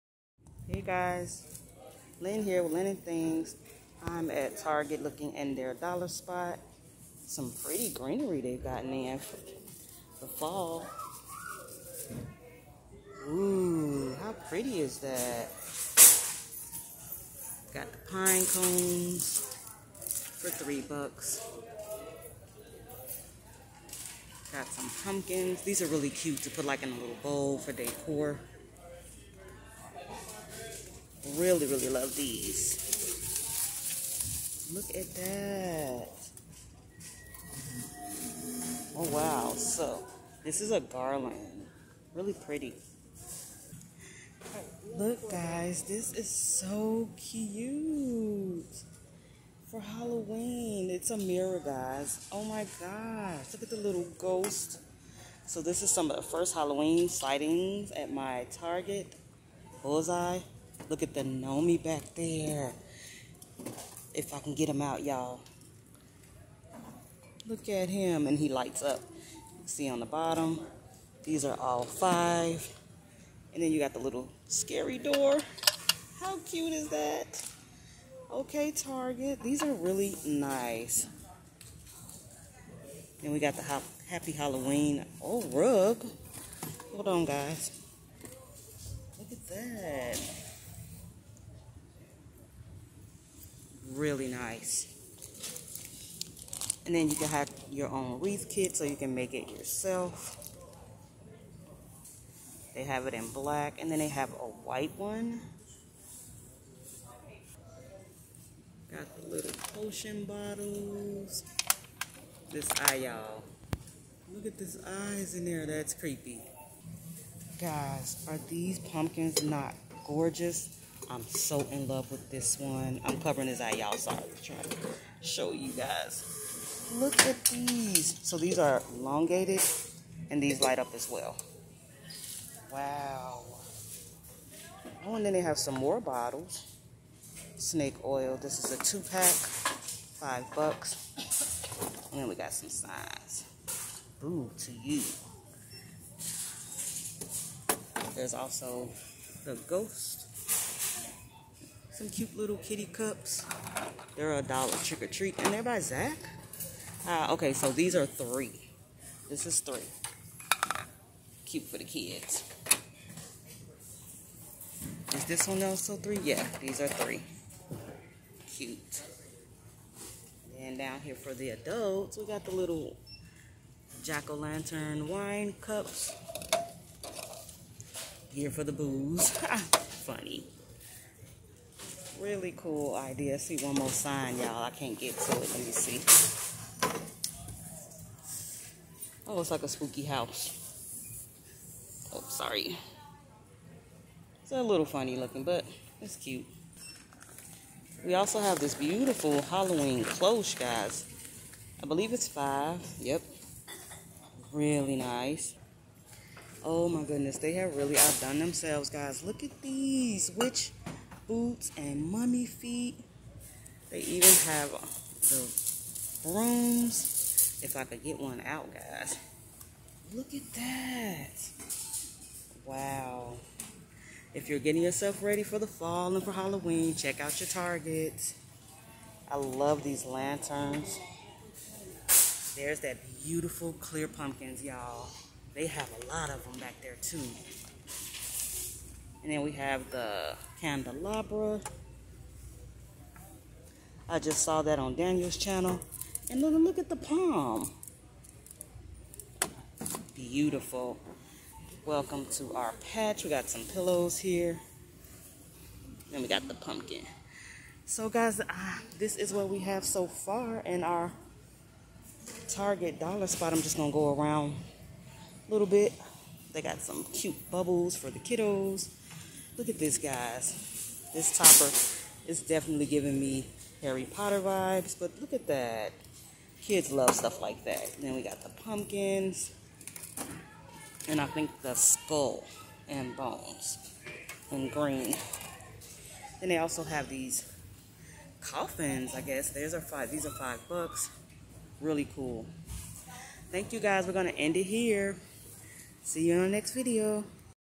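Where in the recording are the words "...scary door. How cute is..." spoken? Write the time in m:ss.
1:14.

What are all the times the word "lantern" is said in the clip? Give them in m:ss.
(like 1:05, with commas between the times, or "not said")
2:54, 3:50.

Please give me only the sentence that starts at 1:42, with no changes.
They have it in black and then they have a white one.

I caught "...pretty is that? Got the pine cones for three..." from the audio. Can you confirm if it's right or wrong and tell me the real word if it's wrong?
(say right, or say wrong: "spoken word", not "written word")
right.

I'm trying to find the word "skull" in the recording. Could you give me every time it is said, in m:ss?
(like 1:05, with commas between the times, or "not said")
4:41.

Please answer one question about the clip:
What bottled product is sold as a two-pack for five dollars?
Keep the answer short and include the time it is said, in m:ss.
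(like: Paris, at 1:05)
Snake oil, at 2:17.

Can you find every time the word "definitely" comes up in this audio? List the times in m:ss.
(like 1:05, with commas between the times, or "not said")
4:32.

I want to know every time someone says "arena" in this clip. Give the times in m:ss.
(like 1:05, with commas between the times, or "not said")
not said.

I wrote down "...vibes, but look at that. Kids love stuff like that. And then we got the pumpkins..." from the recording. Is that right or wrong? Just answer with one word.
right.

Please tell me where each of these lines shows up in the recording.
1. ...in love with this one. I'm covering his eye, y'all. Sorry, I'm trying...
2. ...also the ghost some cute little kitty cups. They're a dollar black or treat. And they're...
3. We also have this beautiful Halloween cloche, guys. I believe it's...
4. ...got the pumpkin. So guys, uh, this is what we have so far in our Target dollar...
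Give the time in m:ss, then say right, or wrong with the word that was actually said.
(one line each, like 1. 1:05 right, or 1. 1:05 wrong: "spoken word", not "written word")
1. 2:01 right
2. 2:28 wrong: "trick", not "black"
3. 3:18 right
4. 4:16 right.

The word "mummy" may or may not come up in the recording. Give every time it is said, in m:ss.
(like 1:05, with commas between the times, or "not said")
3:32.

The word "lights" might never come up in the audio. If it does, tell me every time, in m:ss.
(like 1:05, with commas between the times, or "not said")
1:08, 2:10.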